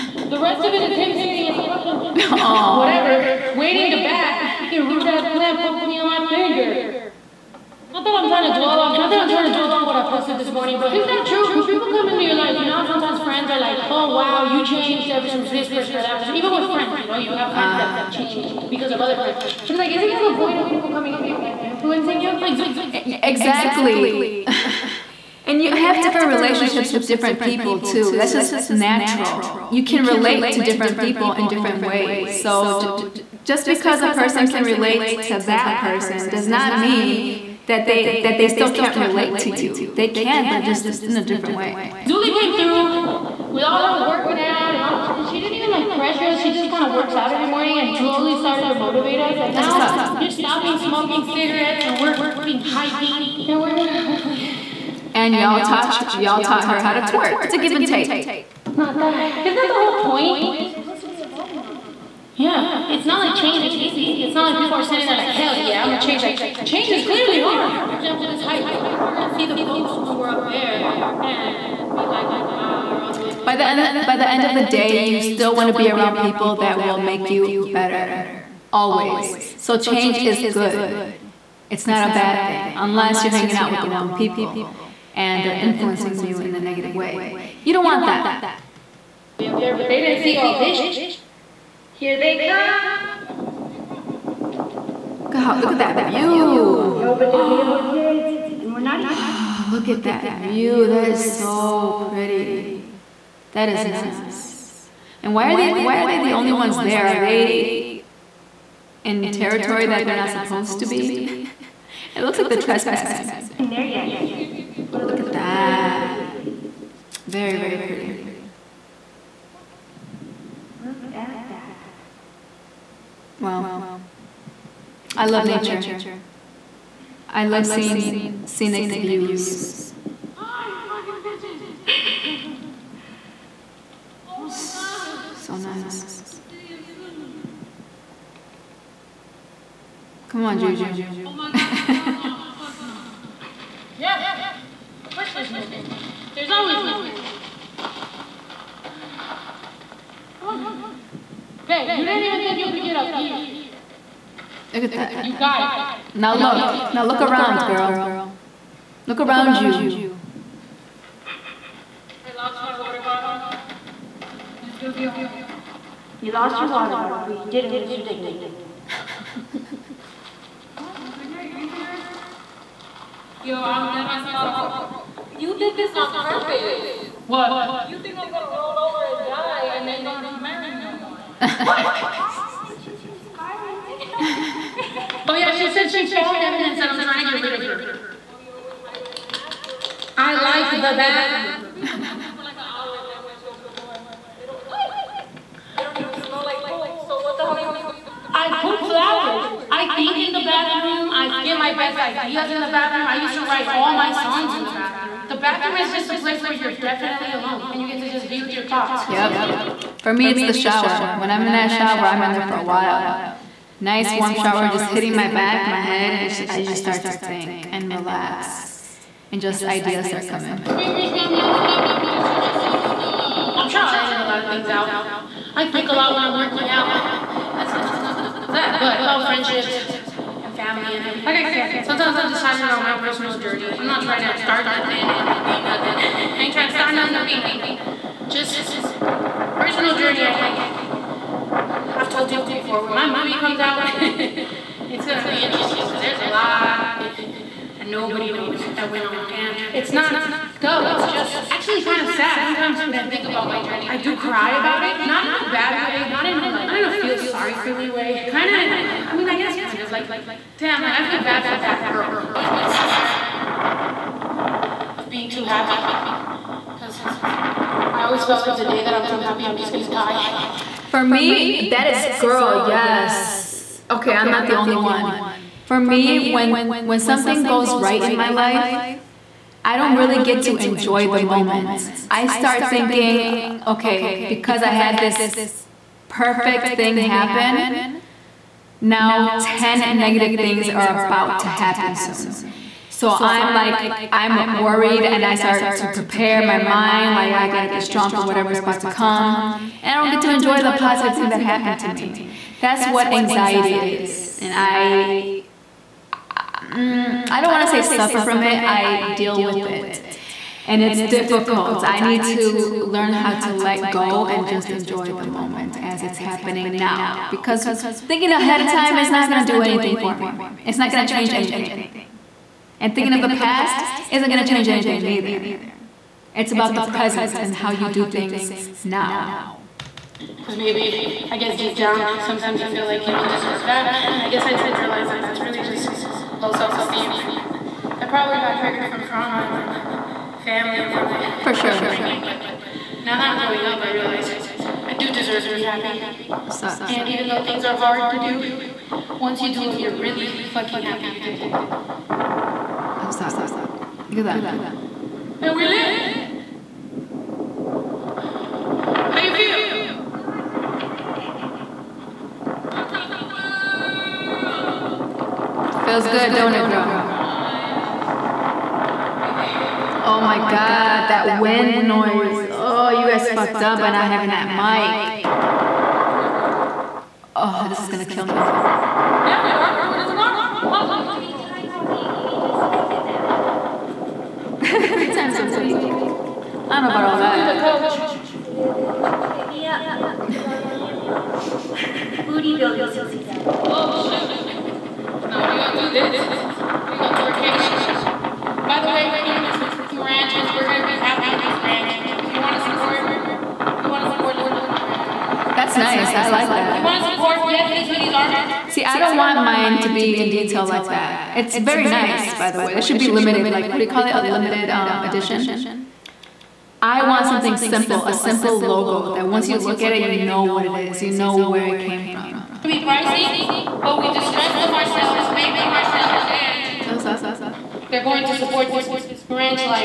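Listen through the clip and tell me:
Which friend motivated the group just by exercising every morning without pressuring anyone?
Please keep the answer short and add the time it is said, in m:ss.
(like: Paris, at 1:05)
Julie, at 0:42.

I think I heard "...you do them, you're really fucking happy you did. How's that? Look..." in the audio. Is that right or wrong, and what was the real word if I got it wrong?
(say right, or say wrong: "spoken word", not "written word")
right.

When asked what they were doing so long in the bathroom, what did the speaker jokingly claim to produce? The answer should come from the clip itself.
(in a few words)
flowers.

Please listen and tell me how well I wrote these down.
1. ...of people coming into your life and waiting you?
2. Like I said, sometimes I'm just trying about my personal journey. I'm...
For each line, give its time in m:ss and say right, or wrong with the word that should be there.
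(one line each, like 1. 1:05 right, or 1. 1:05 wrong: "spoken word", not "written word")
1. 0:20 wrong: "influencing", not "waiting"
2. 3:51 wrong: "talking", not "trying".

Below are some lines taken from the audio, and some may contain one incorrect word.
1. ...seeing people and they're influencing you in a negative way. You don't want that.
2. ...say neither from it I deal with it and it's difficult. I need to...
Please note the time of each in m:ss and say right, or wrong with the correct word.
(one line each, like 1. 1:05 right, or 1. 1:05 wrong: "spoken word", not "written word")
1. 1:23 wrong: "wrong", not "seeing"
2. 5:07 wrong: "suffer", not "neither".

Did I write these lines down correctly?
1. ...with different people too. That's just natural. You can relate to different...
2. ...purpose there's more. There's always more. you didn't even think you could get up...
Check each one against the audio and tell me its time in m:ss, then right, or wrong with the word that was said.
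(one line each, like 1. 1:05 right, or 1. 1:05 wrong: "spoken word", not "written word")
1. 0:26 right
2. 2:25 wrong: "course", not "purpose".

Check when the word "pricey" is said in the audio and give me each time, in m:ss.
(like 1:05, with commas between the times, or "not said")
7:02.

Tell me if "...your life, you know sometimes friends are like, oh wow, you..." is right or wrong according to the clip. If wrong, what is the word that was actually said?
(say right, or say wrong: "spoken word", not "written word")
right.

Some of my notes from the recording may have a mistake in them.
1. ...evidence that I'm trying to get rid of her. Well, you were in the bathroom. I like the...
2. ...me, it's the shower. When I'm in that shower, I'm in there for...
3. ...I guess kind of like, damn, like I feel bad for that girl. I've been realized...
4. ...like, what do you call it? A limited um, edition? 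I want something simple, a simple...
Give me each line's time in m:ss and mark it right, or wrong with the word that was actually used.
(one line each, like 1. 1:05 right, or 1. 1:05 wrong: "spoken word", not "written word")
1. 3:06 right
2. 3:30 right
3. 4:19 wrong: "scared", not "realized"
4. 6:53 right.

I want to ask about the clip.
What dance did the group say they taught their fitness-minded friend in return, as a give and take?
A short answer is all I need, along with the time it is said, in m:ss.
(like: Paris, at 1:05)
twerk, at 0:57.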